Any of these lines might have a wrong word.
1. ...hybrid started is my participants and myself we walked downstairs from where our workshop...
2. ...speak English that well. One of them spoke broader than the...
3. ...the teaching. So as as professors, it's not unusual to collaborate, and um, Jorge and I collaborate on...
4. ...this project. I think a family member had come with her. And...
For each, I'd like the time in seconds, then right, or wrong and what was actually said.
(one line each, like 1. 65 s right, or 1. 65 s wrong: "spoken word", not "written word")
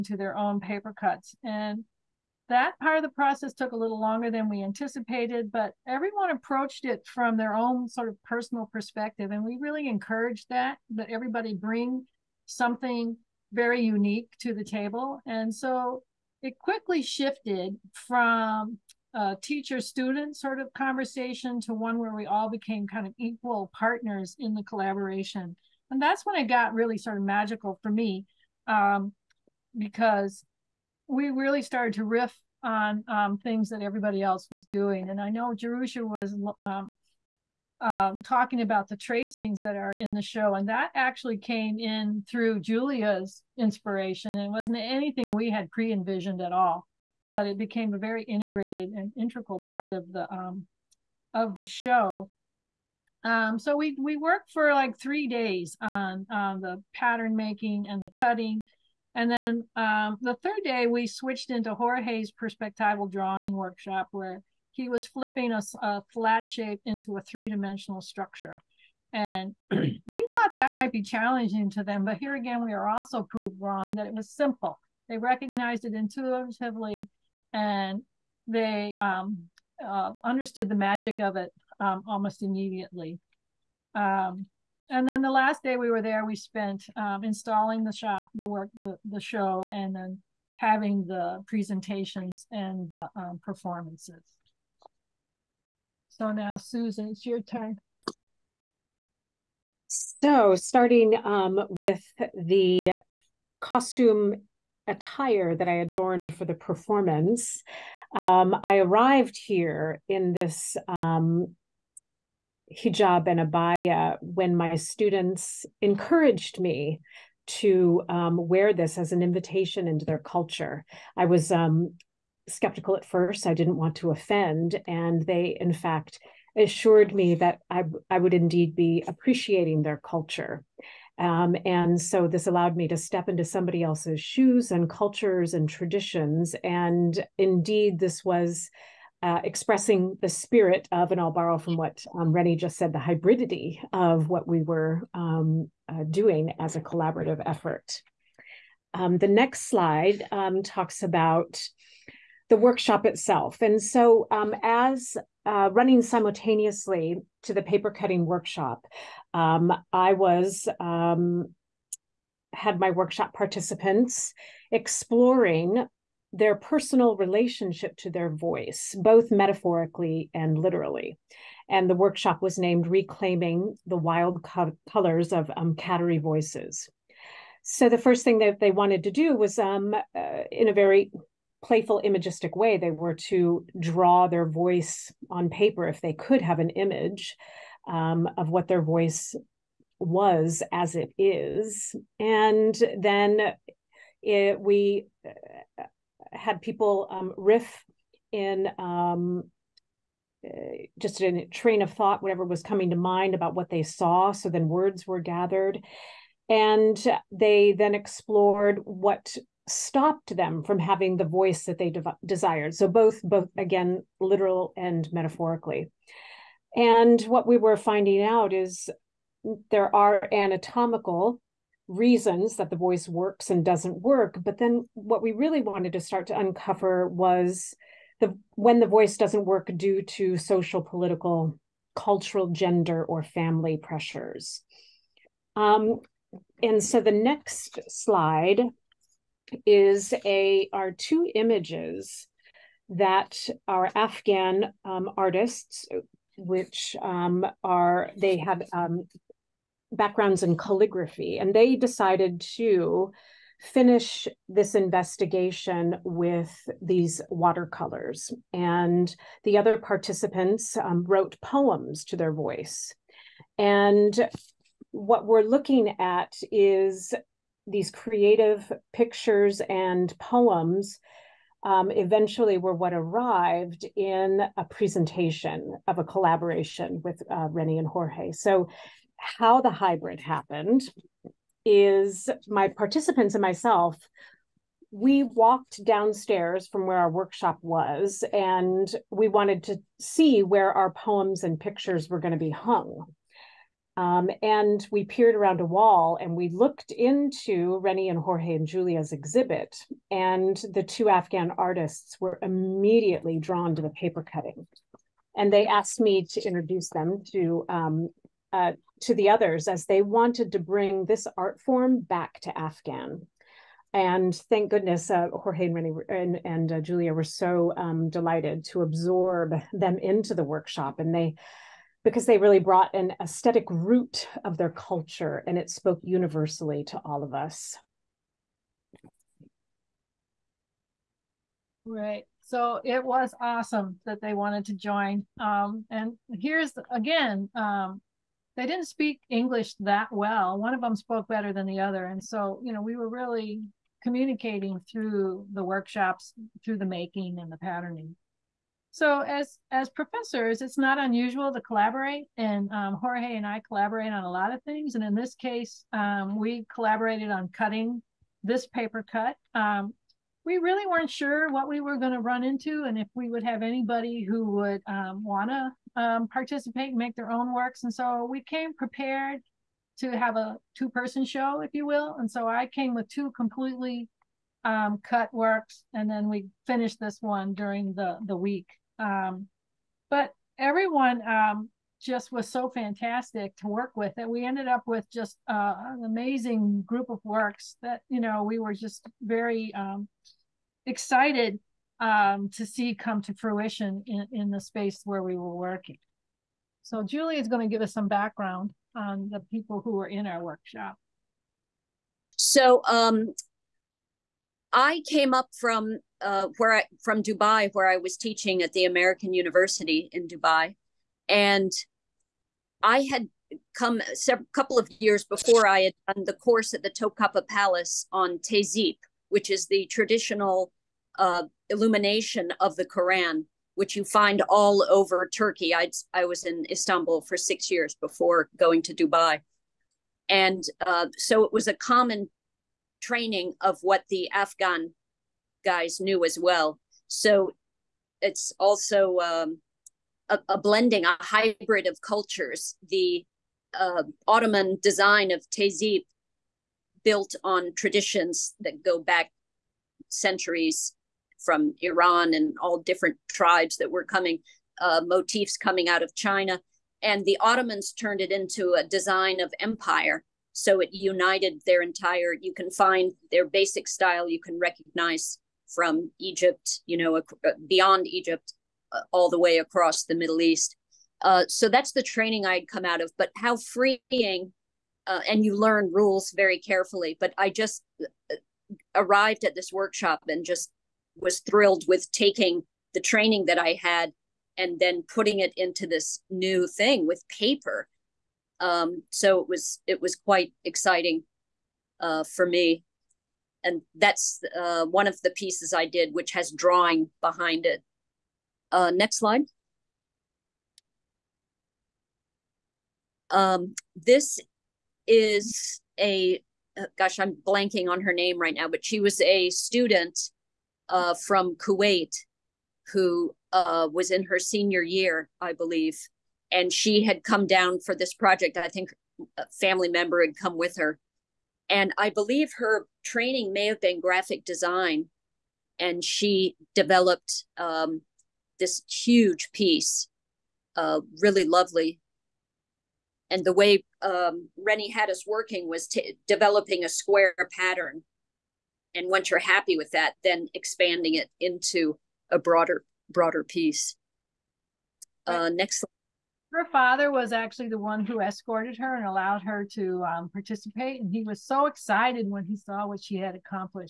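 1. 279 s wrong: "happened", not "started"
2. 338 s wrong: "better", not "broader"
3. 347 s wrong: "patterning", not "teaching"
4. 517 s right.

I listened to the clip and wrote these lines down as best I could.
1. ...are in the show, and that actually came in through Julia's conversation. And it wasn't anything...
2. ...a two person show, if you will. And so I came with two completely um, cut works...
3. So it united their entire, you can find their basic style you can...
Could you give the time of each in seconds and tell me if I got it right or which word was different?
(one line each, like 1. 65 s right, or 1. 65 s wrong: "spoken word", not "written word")
1. 39 s wrong: "inspiration", not "conversation"
2. 370 s right
3. 460 s right.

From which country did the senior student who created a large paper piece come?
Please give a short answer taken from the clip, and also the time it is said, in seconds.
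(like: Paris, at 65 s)
Kuwait, at 511 s.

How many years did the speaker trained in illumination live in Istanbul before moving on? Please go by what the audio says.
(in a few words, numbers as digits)
6.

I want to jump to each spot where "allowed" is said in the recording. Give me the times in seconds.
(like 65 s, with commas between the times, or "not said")
132 s, 549 s.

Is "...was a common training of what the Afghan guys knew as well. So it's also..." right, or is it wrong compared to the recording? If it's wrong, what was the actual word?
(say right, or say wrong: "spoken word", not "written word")
right.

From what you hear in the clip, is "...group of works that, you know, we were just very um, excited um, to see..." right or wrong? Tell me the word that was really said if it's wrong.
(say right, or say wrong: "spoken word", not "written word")
right.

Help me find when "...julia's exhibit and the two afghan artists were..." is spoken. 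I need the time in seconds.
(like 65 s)
298 s.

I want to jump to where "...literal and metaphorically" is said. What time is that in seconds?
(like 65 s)
214 s.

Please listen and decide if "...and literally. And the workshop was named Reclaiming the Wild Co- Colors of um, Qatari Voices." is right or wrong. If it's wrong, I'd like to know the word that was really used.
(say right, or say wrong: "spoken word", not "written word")
right.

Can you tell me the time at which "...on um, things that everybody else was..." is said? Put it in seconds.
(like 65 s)
32 s.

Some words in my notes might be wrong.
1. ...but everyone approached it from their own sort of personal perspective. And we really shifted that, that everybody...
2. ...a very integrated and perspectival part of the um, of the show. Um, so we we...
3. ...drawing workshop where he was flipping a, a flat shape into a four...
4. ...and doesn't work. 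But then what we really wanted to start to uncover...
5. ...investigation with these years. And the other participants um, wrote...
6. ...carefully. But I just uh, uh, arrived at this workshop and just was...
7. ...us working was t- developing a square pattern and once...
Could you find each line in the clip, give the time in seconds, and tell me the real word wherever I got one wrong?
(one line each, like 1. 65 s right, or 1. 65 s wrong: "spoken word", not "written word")
1. 5 s wrong: "encouraged", not "shifted"
2. 47 s wrong: "integral", not "perspectival"
3. 63 s wrong: "three", not "four"
4. 223 s right
5. 254 s wrong: "watercolors", not "years"
6. 476 s right
7. 535 s right.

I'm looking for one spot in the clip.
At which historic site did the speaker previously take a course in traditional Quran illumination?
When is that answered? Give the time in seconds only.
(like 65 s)
416 s.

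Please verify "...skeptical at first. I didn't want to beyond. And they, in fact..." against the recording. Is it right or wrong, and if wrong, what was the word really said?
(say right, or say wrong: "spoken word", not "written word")
wrong: "offend", not "beyond".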